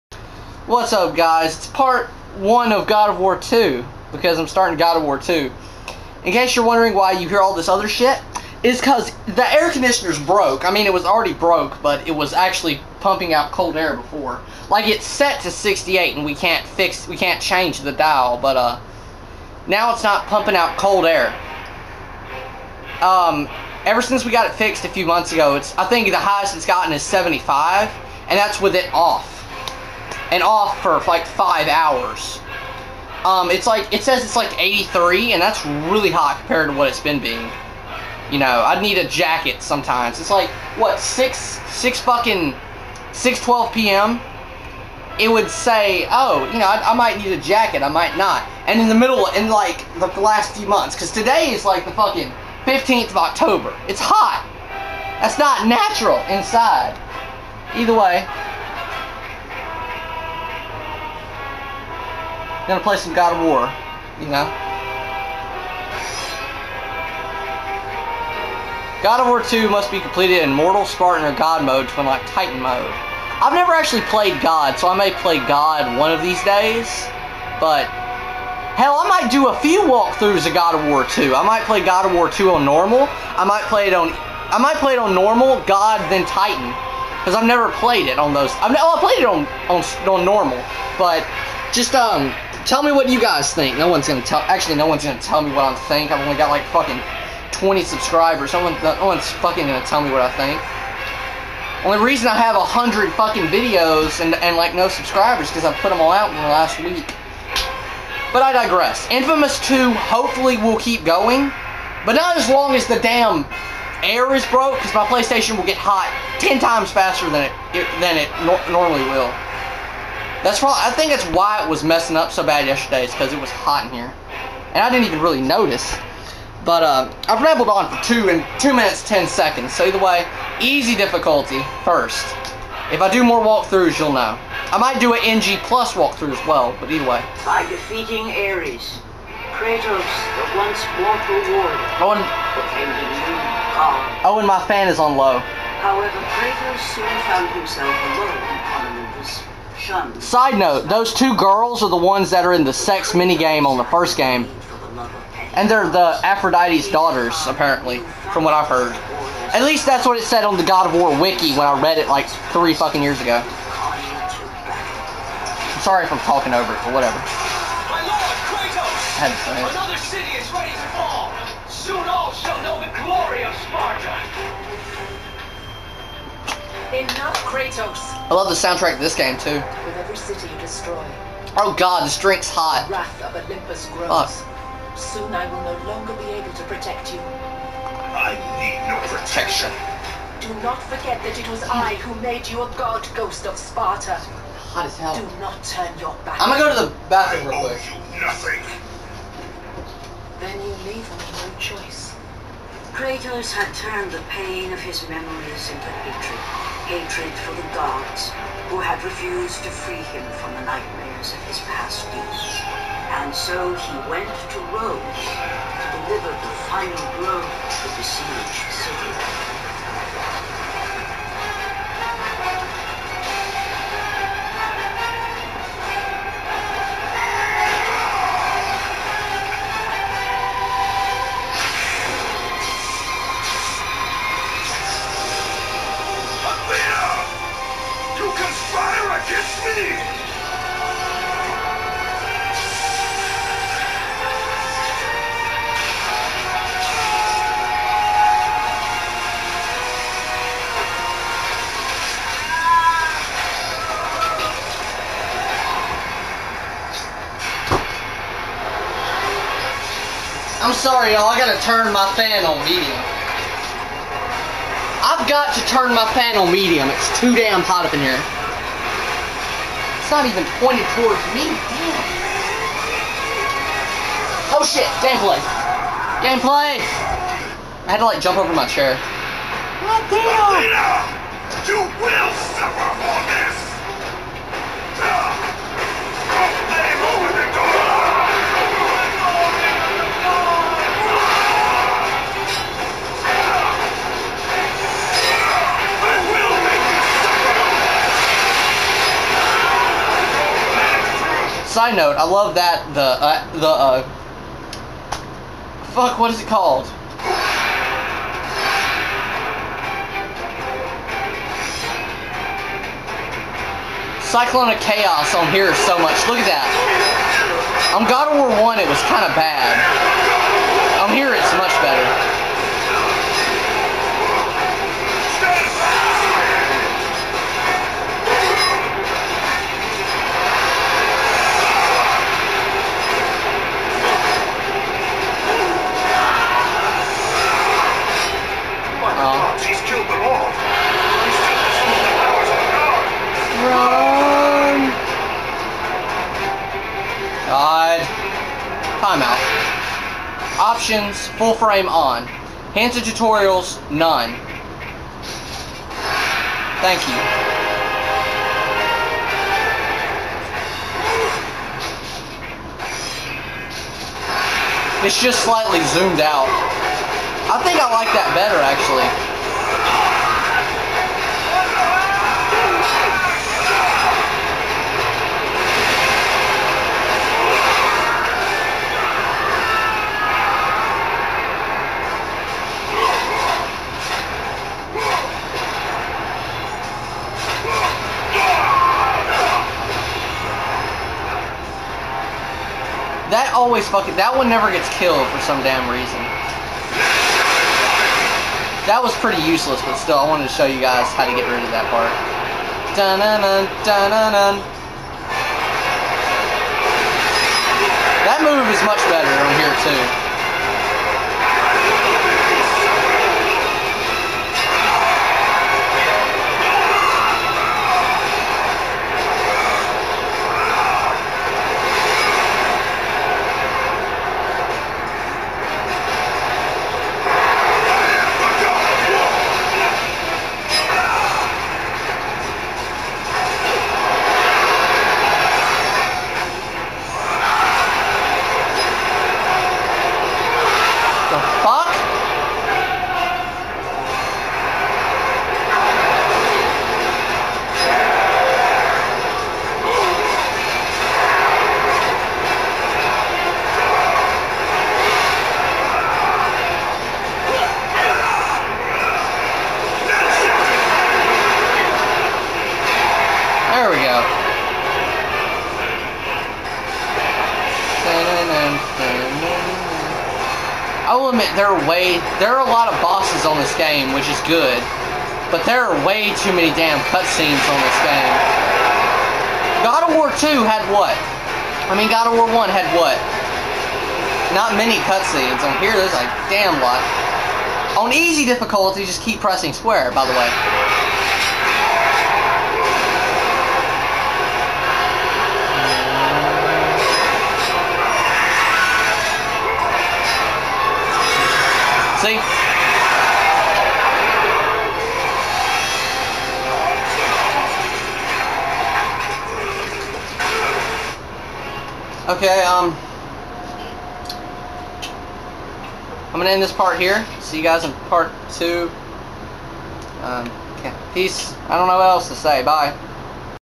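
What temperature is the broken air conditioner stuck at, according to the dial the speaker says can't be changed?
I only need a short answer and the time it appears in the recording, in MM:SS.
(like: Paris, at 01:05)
68, at 00:15.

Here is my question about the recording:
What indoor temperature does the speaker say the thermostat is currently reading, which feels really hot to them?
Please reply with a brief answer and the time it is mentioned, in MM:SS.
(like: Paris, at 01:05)
83, at 00:34.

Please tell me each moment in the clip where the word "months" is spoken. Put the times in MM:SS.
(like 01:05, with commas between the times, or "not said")
00:25, 00:50.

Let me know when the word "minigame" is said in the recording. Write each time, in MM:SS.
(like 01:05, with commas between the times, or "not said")
02:33.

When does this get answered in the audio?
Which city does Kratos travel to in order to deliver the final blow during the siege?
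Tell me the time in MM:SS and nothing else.
03:34.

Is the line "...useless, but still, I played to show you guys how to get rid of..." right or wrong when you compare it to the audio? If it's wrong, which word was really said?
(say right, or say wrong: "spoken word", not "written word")
wrong: "wanted", not "played".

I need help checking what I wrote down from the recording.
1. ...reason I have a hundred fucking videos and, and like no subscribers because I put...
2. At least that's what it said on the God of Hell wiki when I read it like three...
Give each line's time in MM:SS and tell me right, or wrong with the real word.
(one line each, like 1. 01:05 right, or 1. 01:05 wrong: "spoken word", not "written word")
1. 01:42 right
2. 02:39 wrong: "War", not "Hell".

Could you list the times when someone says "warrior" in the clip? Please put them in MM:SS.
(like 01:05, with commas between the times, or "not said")
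02:21.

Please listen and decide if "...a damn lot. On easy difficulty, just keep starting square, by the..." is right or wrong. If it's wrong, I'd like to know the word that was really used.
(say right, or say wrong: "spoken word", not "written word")
wrong: "pressing", not "starting".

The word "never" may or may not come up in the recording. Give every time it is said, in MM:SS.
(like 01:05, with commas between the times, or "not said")
01:13, 01:27, 06:34.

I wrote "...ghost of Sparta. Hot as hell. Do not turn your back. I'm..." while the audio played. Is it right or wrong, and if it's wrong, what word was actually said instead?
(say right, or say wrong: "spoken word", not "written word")
right.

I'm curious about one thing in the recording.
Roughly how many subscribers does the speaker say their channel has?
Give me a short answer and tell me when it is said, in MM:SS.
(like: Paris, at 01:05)
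20, at 01:37.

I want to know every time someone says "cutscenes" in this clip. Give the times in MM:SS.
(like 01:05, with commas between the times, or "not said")
07:57, 08:05.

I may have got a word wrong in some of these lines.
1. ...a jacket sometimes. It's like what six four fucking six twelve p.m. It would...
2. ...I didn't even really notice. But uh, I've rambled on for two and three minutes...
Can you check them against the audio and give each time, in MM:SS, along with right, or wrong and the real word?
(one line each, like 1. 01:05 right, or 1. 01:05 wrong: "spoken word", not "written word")
1. 00:38 wrong: "six", not "four"
2. 02:04 wrong: "two", not "three".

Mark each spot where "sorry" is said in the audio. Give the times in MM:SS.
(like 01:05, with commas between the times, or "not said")
02:45, 04:20.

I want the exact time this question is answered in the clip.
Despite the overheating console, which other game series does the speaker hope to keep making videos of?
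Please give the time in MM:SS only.
01:49.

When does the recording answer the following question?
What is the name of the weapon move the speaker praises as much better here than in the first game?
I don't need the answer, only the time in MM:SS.
05:14.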